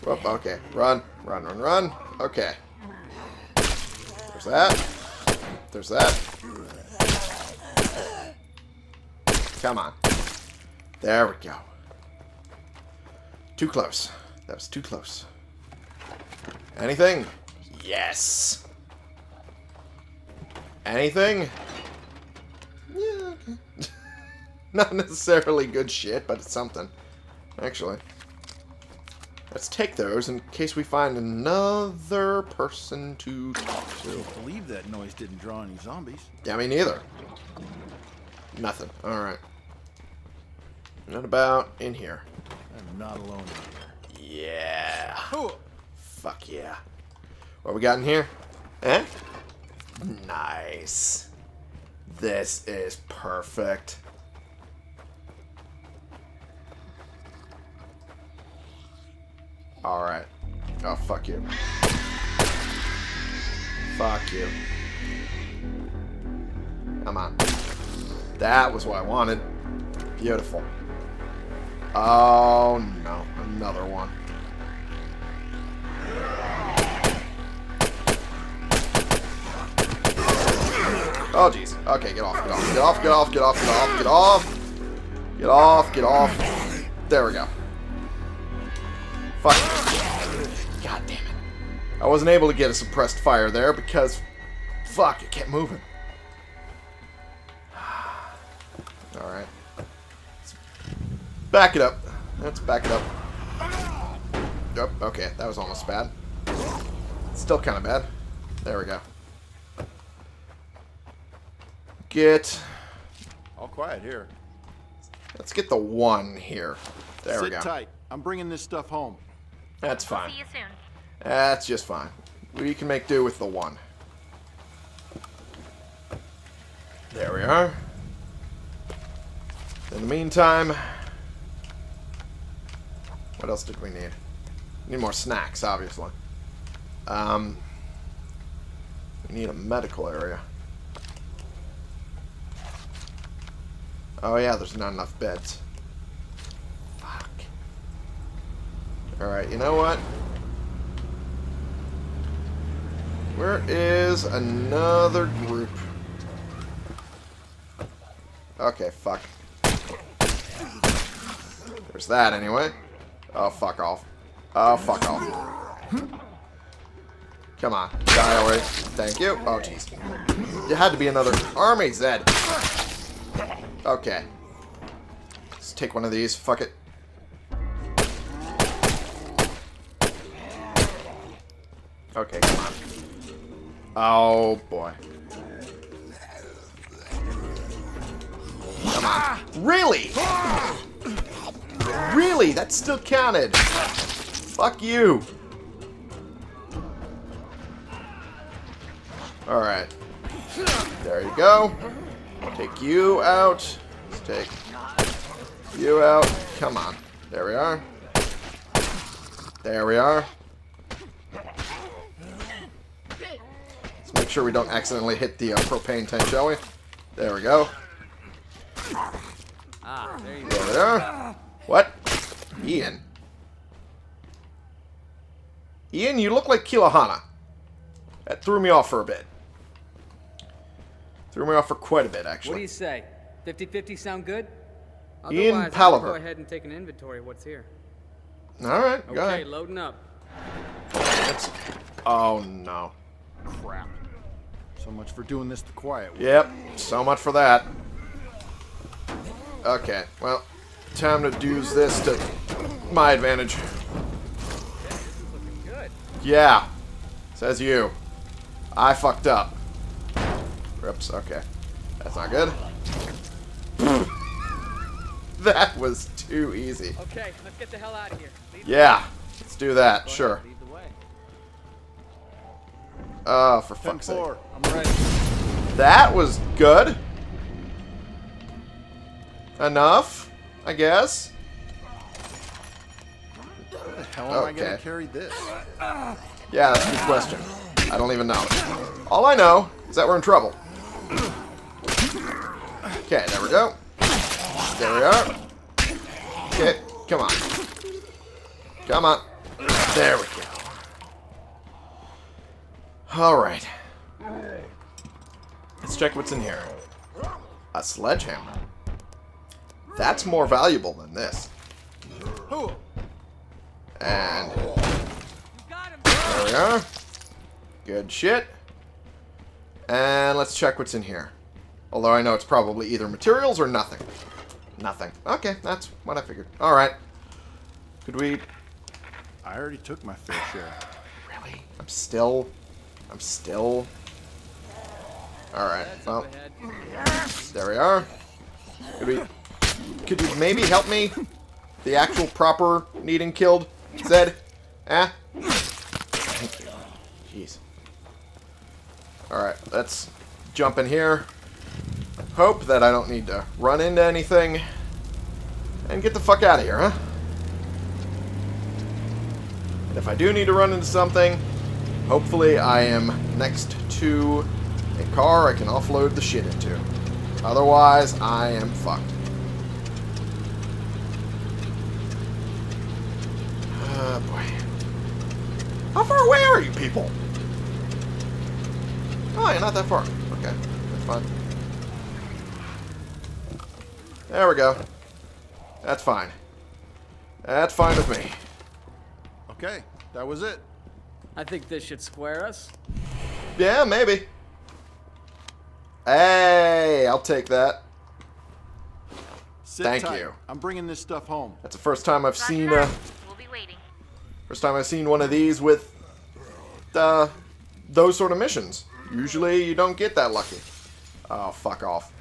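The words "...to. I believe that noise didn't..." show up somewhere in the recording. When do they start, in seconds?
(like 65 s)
34 s.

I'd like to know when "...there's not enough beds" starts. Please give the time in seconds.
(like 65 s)
144 s.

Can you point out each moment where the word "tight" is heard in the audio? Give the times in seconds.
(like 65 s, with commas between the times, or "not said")
117 s, 400 s.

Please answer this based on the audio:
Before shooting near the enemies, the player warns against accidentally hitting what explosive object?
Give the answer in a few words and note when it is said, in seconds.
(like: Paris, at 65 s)
propane tank, at 215 s.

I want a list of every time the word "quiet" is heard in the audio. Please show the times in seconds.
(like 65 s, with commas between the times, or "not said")
113 s, 245 s.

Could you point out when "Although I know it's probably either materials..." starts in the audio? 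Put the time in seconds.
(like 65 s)
321 s.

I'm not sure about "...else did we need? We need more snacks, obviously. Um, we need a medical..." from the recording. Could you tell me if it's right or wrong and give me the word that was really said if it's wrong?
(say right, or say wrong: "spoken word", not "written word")
right.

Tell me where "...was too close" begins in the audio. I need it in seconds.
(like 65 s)
14 s.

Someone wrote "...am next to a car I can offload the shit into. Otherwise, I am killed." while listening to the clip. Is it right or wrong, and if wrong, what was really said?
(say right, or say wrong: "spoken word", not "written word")
wrong: "fucked", not "killed".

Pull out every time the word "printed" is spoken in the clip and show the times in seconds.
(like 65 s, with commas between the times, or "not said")
not said.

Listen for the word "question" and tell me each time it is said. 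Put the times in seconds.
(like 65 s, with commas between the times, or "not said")
287 s.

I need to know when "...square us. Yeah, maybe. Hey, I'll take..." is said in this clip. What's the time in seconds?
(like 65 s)
392 s.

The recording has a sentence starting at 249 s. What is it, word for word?
Okay, well, time to use this to my advantage.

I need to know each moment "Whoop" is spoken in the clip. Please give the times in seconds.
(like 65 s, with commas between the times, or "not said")
0 s.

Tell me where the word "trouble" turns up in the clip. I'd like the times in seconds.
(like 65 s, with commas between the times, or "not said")
290 s.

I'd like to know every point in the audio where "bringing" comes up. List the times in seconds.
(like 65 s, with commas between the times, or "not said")
118 s, 400 s.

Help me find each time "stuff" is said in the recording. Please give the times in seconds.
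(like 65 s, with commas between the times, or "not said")
118 s, 400 s.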